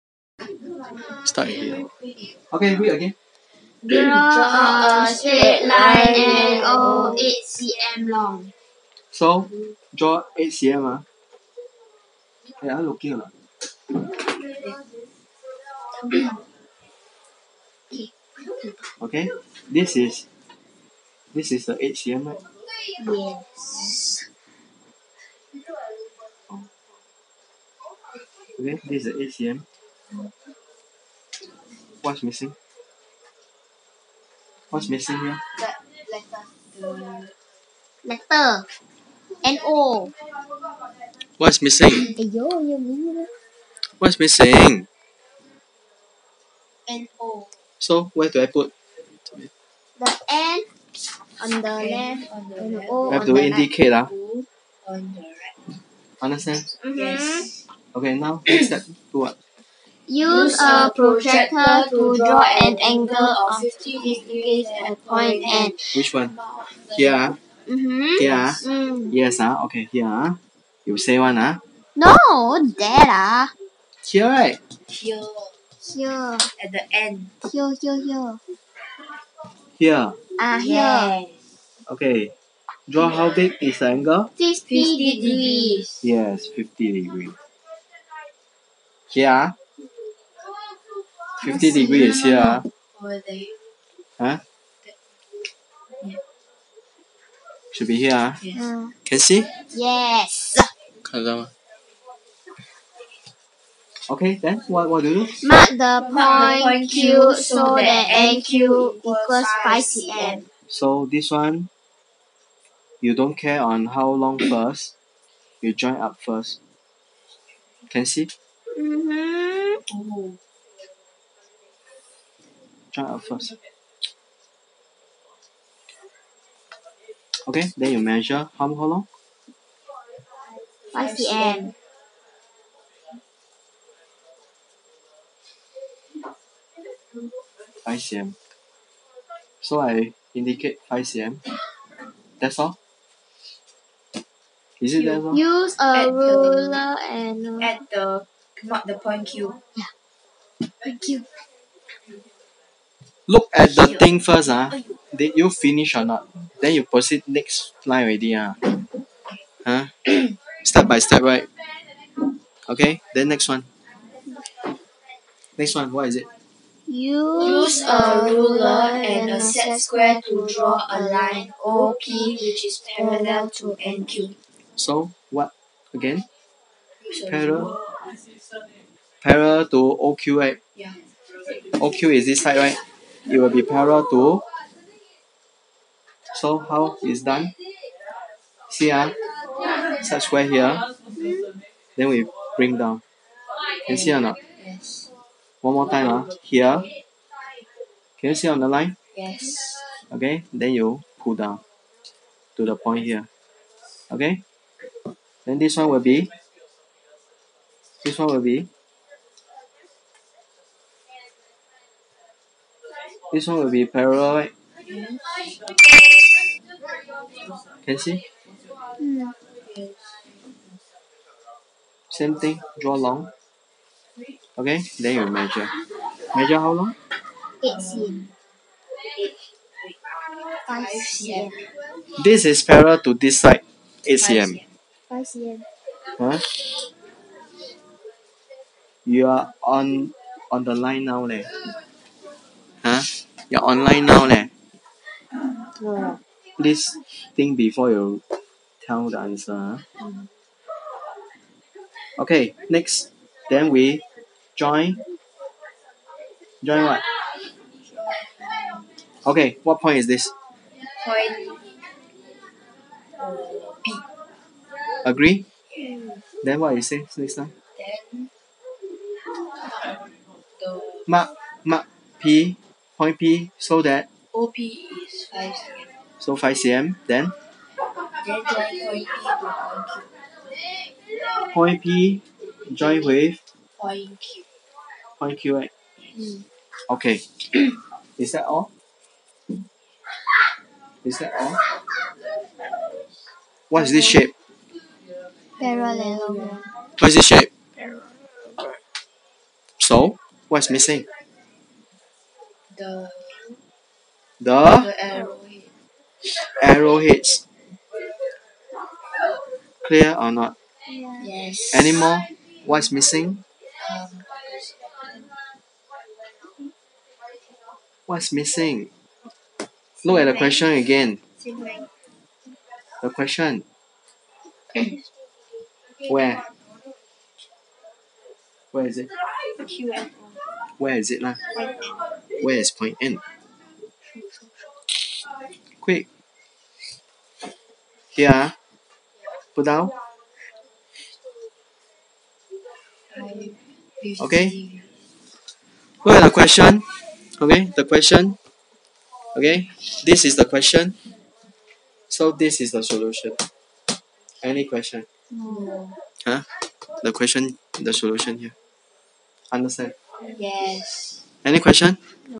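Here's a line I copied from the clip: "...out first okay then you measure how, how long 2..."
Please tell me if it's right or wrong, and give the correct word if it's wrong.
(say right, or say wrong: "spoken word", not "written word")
wrong: "5", not "2".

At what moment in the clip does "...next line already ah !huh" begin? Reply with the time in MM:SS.
02:37.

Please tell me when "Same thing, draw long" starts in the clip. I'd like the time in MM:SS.
03:42.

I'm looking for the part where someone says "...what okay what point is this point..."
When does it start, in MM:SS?
04:16.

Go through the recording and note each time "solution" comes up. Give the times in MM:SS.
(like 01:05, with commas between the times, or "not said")
05:52, 05:57.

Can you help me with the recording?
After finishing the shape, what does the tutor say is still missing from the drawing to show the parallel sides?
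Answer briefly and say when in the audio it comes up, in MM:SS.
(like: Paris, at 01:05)
arrowheads, at 05:06.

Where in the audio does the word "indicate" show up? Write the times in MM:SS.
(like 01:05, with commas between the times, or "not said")
00:53, 02:20.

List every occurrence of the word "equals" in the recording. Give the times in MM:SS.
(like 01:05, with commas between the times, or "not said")
01:48.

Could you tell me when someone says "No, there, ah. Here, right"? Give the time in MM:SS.
01:11.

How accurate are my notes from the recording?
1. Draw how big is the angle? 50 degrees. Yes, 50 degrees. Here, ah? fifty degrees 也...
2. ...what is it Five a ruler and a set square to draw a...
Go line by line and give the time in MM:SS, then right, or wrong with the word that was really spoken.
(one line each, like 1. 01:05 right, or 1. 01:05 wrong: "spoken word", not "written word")
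1. 01:22 right
2. 02:45 wrong: "Use", not "Five".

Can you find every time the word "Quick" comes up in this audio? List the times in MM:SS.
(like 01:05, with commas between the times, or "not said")
05:35.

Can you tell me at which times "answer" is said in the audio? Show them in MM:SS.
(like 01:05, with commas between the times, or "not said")
04:09.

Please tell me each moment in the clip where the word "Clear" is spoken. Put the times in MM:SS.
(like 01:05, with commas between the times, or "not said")
05:09.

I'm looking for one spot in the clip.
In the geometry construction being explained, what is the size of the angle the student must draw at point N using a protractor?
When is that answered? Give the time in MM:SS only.
01:02.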